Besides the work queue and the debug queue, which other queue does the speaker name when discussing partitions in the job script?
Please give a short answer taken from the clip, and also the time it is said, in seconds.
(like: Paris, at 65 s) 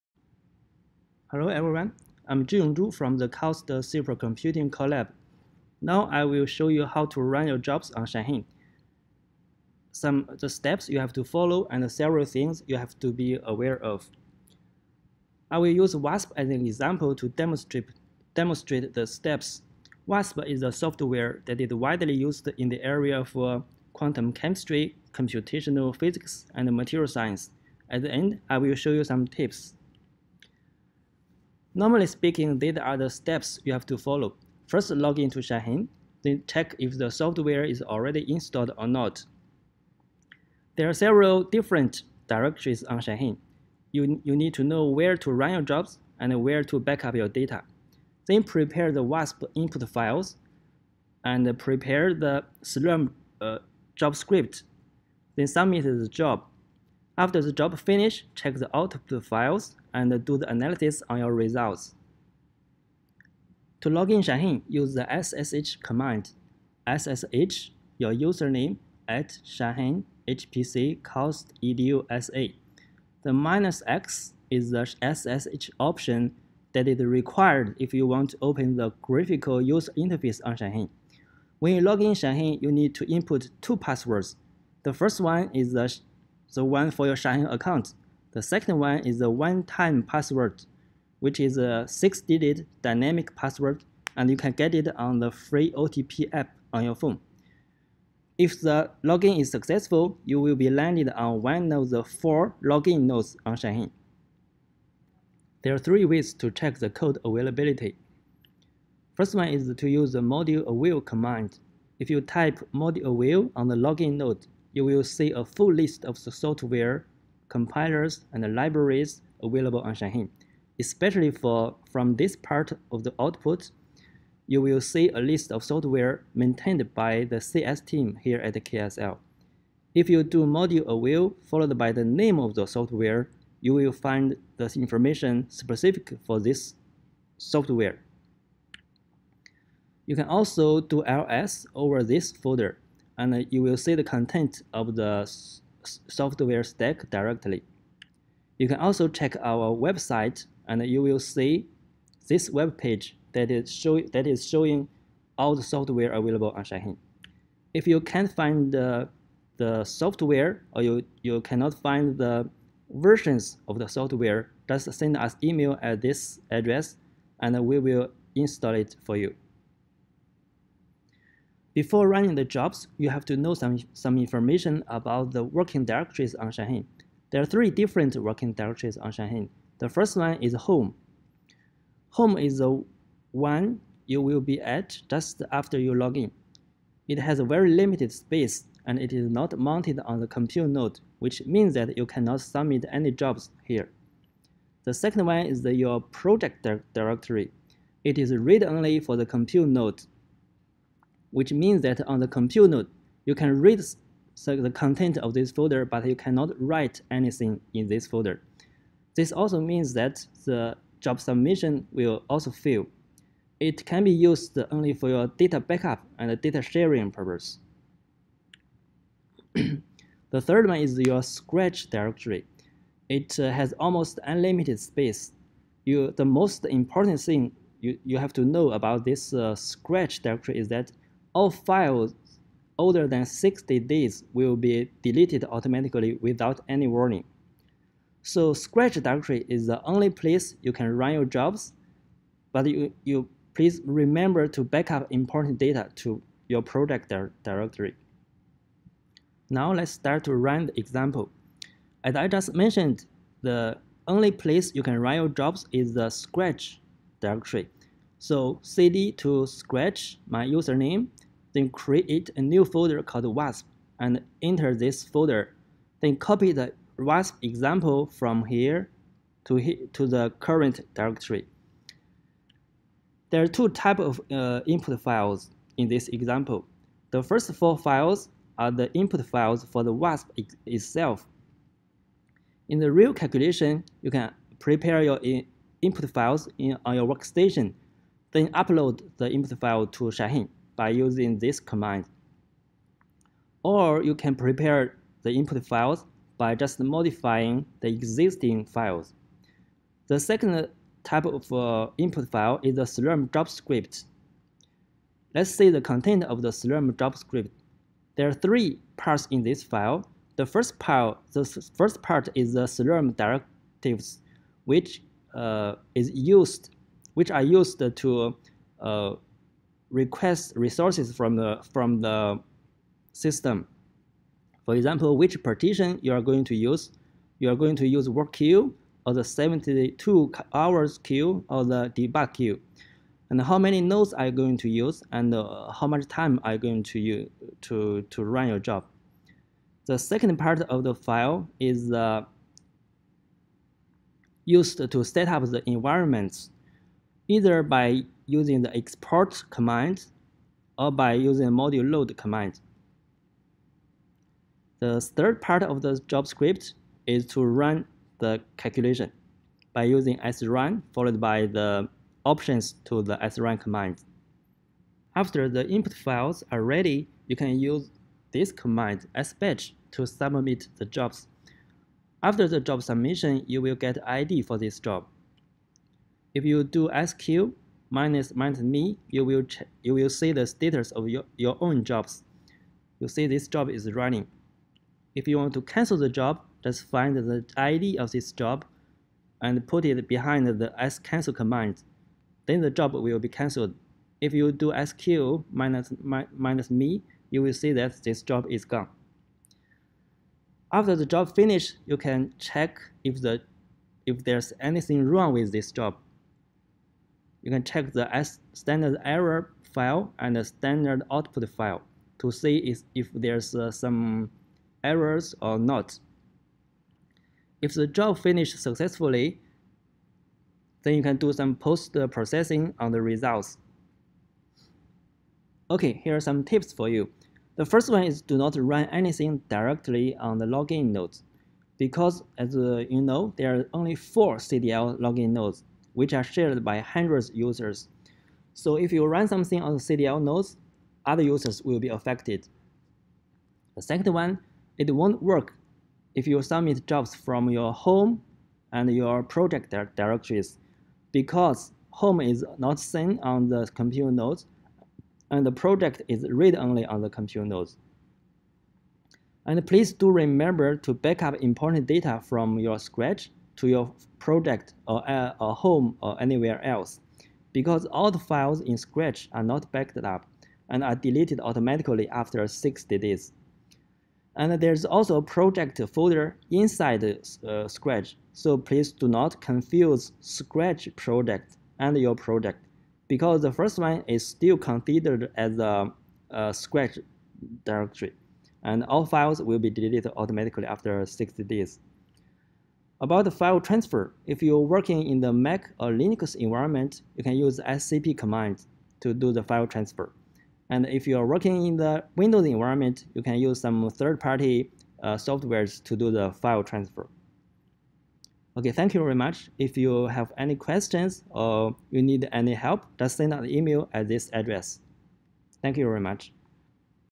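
72 hours queue, at 329 s.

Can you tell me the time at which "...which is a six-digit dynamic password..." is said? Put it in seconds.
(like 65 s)
91 s.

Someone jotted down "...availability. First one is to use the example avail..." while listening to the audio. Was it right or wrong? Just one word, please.
wrong.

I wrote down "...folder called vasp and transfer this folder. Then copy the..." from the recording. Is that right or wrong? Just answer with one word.
wrong.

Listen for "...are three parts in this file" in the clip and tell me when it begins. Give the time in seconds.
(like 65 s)
308 s.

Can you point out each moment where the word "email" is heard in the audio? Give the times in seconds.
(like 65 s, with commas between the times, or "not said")
165 s, 513 s.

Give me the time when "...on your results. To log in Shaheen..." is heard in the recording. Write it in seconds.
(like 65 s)
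61 s.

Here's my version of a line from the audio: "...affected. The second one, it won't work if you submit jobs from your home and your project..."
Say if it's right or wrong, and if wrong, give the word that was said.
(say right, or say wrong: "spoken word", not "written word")
right.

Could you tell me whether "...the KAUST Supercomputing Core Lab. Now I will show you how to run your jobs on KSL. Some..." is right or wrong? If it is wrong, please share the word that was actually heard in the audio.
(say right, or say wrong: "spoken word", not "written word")
wrong: "Shaheen", not "KSL".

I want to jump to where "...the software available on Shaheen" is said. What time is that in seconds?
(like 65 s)
155 s.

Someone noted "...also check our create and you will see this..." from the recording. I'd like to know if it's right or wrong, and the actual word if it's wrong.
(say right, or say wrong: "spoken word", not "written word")
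wrong: "website", not "create".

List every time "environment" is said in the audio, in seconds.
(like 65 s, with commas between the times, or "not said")
345 s, 496 s, 502 s.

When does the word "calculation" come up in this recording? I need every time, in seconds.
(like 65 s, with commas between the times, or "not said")
283 s, 358 s.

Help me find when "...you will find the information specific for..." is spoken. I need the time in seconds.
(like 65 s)
133 s.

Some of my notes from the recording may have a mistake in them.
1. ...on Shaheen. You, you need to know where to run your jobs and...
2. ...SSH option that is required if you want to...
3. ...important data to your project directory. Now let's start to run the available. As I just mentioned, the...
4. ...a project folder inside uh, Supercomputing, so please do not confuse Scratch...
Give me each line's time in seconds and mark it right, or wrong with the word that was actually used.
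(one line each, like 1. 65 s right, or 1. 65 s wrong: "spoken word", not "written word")
1. 42 s right
2. 75 s right
3. 245 s wrong: "example", not "available"
4. 475 s wrong: "Scratch", not "Supercomputing".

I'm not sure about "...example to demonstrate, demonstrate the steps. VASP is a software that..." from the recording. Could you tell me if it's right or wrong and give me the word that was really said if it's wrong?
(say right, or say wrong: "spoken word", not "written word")
right.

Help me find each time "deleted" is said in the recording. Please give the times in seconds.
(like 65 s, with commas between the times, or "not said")
235 s, 470 s, 489 s.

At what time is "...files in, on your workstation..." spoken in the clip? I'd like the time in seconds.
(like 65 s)
286 s.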